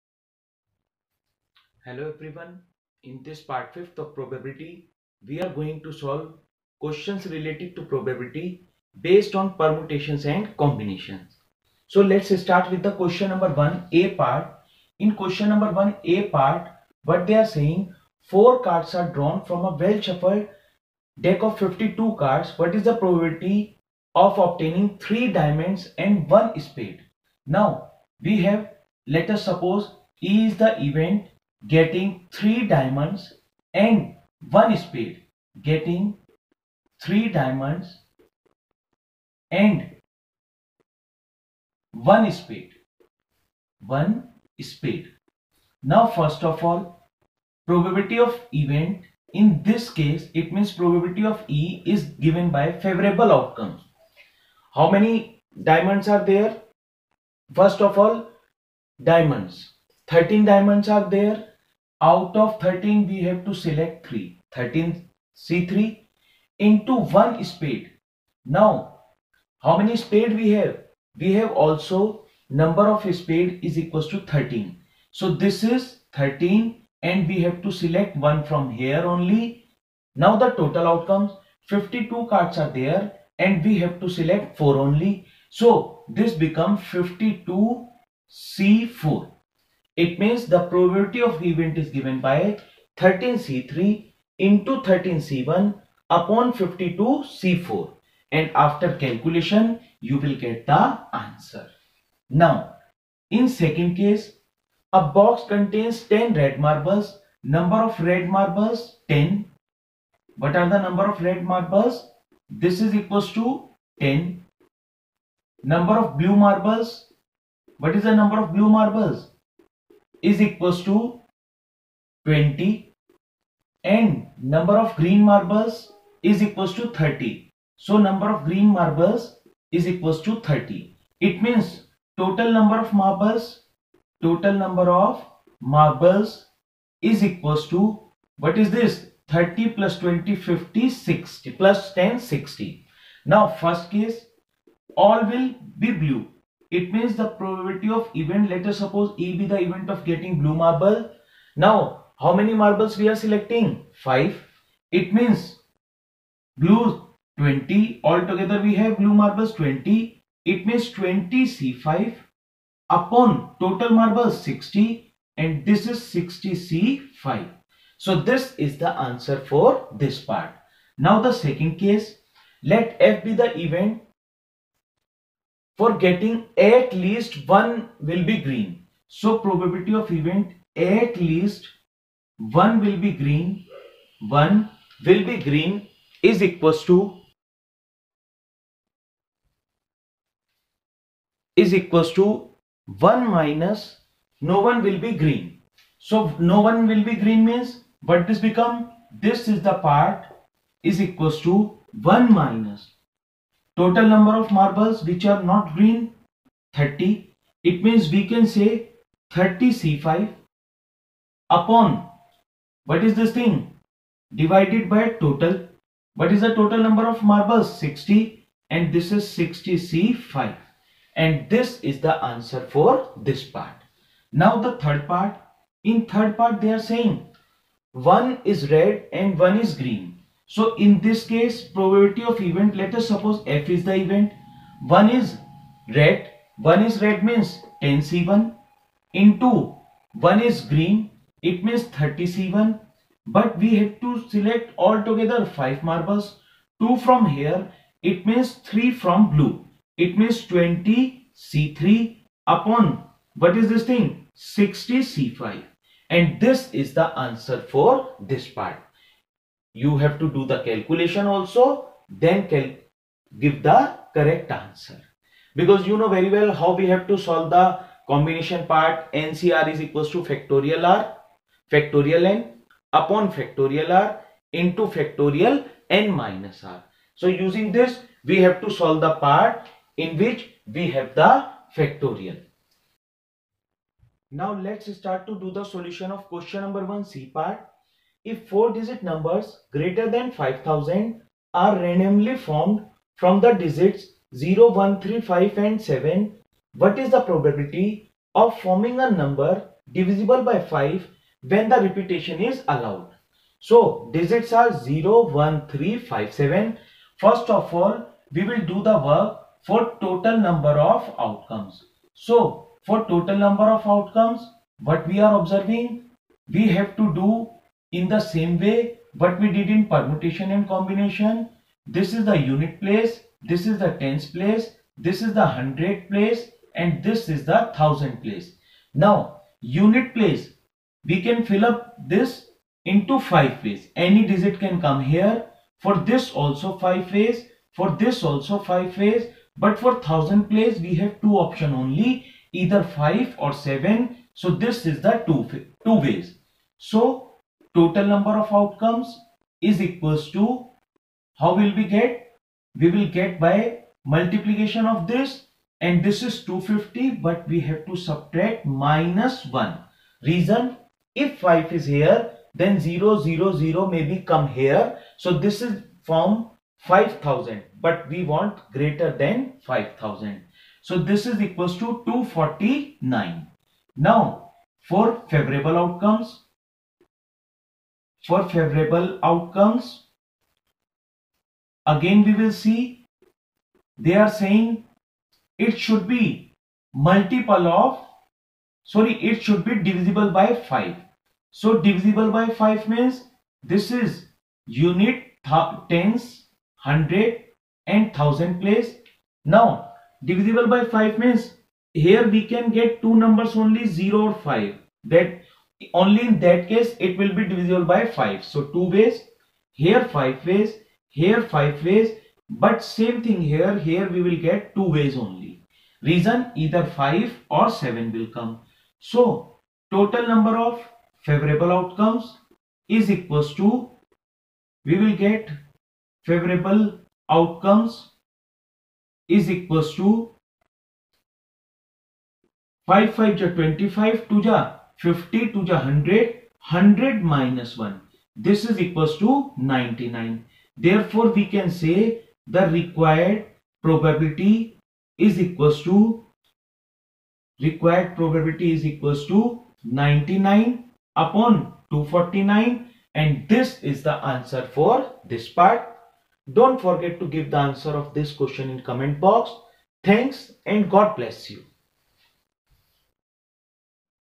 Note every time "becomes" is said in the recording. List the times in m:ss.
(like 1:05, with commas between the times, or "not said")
1:26, 3:18.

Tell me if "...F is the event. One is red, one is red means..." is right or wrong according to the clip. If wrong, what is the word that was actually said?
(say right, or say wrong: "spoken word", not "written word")
right.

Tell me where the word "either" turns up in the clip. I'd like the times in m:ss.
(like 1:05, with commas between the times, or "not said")
5:42, 6:56.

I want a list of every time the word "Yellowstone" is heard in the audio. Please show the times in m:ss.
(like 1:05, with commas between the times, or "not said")
not said.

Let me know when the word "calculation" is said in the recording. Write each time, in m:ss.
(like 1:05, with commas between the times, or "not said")
1:39, 4:20.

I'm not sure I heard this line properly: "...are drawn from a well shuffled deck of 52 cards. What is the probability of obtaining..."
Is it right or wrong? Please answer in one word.
right.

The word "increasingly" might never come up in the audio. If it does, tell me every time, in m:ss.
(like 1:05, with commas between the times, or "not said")
not said.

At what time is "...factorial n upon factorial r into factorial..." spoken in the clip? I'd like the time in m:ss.
4:31.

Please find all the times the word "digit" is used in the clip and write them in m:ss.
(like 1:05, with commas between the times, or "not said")
4:48, 4:53, 5:04, 5:34.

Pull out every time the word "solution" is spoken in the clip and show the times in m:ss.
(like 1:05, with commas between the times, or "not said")
4:45.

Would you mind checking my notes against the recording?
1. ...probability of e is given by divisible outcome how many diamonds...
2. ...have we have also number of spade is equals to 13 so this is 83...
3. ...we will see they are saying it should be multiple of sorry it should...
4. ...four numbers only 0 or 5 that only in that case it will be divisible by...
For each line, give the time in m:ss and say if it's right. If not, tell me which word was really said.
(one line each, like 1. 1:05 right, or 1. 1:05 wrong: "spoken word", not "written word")
1. 0:50 wrong: "favorable", not "divisible"
2. 1:10 wrong: "13", not "83"
3. 6:22 right
4. 6:43 wrong: "two", not "four".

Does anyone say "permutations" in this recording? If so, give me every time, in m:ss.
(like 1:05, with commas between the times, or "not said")
0:09, 5:19.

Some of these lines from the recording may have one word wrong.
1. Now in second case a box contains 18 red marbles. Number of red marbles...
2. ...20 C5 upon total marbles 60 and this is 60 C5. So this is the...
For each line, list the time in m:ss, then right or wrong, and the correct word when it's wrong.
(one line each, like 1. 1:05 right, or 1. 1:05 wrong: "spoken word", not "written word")
1. 1:42 wrong: "10", not "18"
2. 2:40 right.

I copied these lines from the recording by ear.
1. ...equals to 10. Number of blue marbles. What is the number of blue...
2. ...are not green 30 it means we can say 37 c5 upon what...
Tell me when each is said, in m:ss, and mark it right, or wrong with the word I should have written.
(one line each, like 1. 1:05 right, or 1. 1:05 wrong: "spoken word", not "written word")
1. 1:52 right
2. 3:25 wrong: "30", not "37".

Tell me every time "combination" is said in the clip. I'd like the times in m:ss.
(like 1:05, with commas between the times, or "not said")
0:10, 4:28, 5:20.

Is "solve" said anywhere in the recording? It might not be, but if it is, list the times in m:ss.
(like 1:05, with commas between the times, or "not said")
0:05, 4:27, 4:38.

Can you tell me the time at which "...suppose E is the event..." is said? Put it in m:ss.
0:29.